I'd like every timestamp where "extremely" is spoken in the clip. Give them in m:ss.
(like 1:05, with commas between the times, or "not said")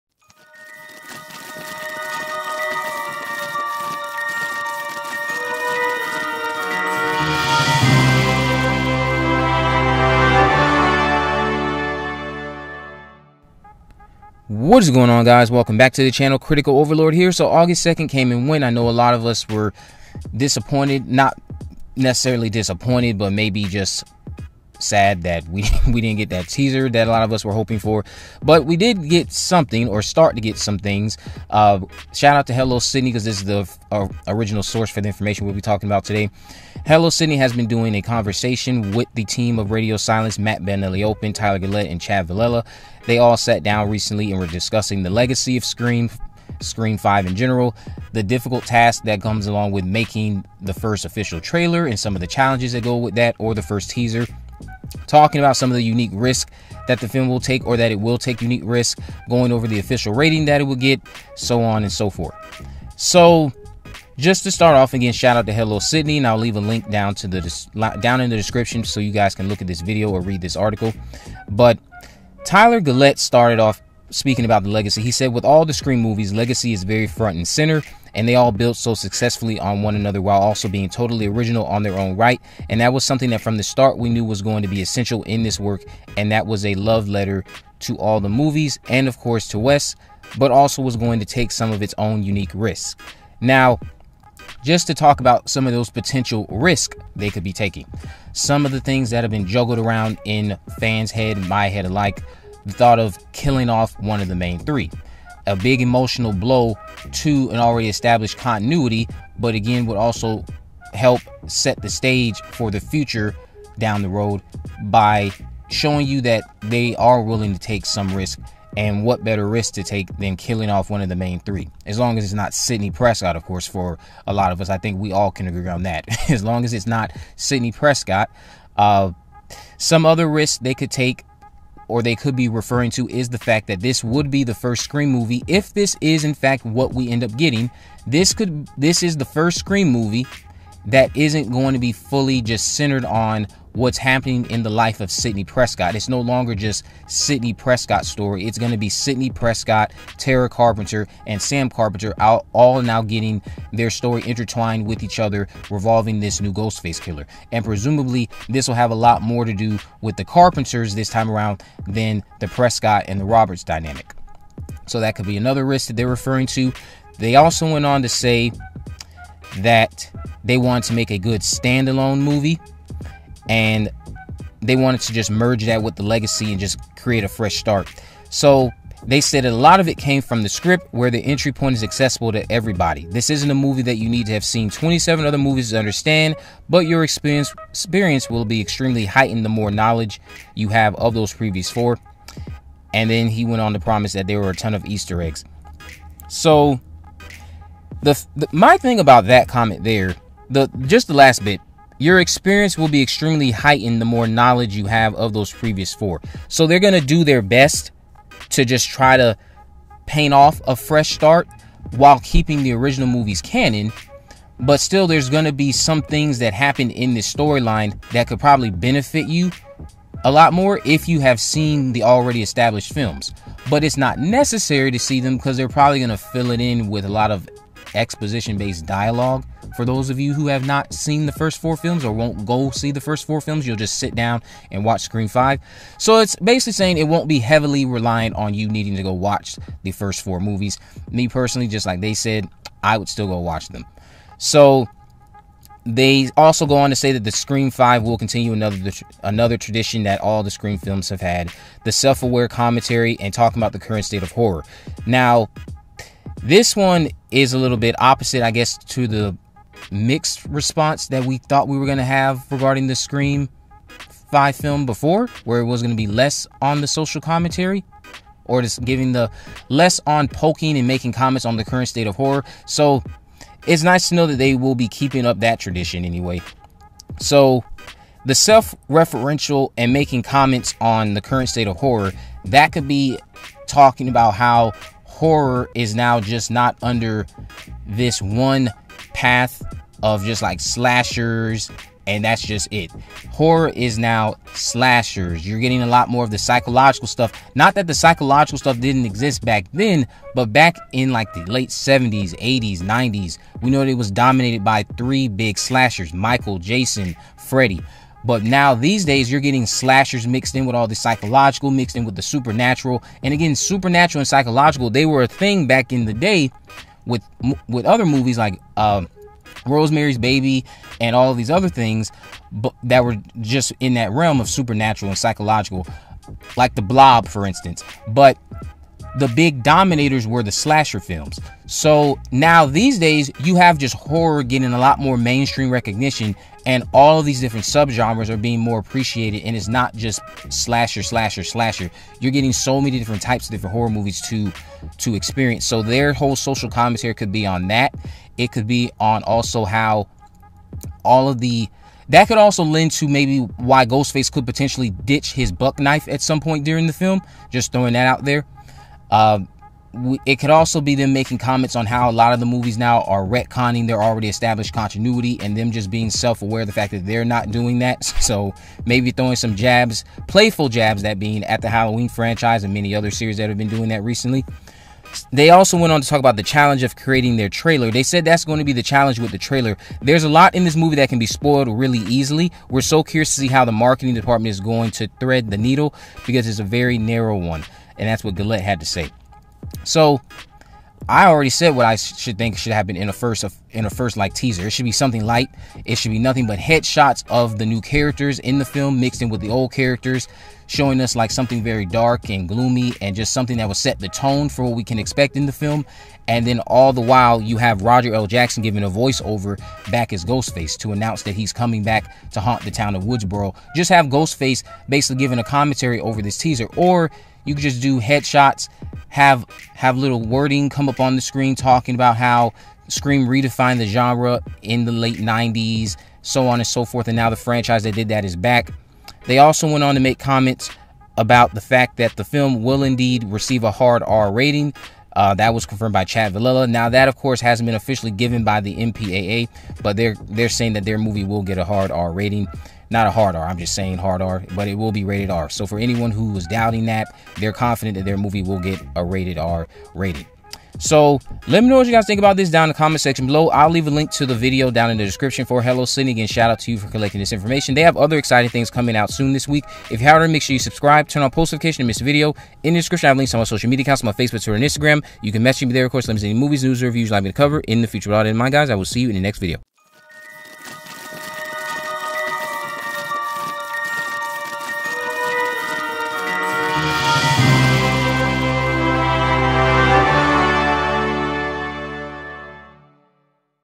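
3:08, 3:22.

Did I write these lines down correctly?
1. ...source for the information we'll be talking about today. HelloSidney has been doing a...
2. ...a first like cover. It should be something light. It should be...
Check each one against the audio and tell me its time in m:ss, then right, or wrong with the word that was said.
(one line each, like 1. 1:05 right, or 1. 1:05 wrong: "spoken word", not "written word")
1. 0:34 right
2. 6:33 wrong: "teaser", not "cover".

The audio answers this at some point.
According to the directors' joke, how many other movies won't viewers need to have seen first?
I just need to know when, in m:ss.
3:04.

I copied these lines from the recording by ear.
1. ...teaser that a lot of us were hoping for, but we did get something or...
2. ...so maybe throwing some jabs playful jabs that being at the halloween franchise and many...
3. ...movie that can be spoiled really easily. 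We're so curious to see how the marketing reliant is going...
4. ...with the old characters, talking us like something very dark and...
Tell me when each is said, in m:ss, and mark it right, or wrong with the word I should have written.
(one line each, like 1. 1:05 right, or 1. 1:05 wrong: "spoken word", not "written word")
1. 0:26 right
2. 6:08 right
3. 6:20 wrong: "department", not "reliant"
4. 6:39 wrong: "showing", not "talking".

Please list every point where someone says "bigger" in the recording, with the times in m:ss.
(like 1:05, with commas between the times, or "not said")
not said.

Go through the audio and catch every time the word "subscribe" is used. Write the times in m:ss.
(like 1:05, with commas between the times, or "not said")
7:40.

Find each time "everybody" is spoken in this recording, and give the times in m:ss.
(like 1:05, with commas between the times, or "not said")
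3:02.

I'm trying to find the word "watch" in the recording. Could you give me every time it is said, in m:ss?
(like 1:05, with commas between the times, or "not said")
3:54, 3:59, 4:03.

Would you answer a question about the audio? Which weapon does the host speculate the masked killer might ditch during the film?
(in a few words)
Buck knife.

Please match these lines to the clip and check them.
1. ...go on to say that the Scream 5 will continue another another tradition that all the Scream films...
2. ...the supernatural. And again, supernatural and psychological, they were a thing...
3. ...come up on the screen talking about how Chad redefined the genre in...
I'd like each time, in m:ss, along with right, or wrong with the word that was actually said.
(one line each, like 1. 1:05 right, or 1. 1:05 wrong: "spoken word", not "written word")
1. 4:06 right
2. 5:12 right
3. 7:00 wrong: "Scream", not "Chad".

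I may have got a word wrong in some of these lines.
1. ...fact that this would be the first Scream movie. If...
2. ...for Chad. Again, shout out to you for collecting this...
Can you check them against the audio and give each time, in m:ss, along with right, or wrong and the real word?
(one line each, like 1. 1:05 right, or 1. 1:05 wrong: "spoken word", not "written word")
1. 2:13 right
2. 7:35 wrong: "HelloSidney", not "Chad".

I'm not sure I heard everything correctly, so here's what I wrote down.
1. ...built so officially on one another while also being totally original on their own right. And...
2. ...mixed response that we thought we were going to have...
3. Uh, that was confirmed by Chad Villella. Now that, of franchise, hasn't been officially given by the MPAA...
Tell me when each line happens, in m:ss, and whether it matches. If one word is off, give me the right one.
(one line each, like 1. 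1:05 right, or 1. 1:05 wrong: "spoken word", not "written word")
1. 1:18 wrong: "successfully", not "officially"
2. 4:19 right
3. 7:15 wrong: "course", not "franchise".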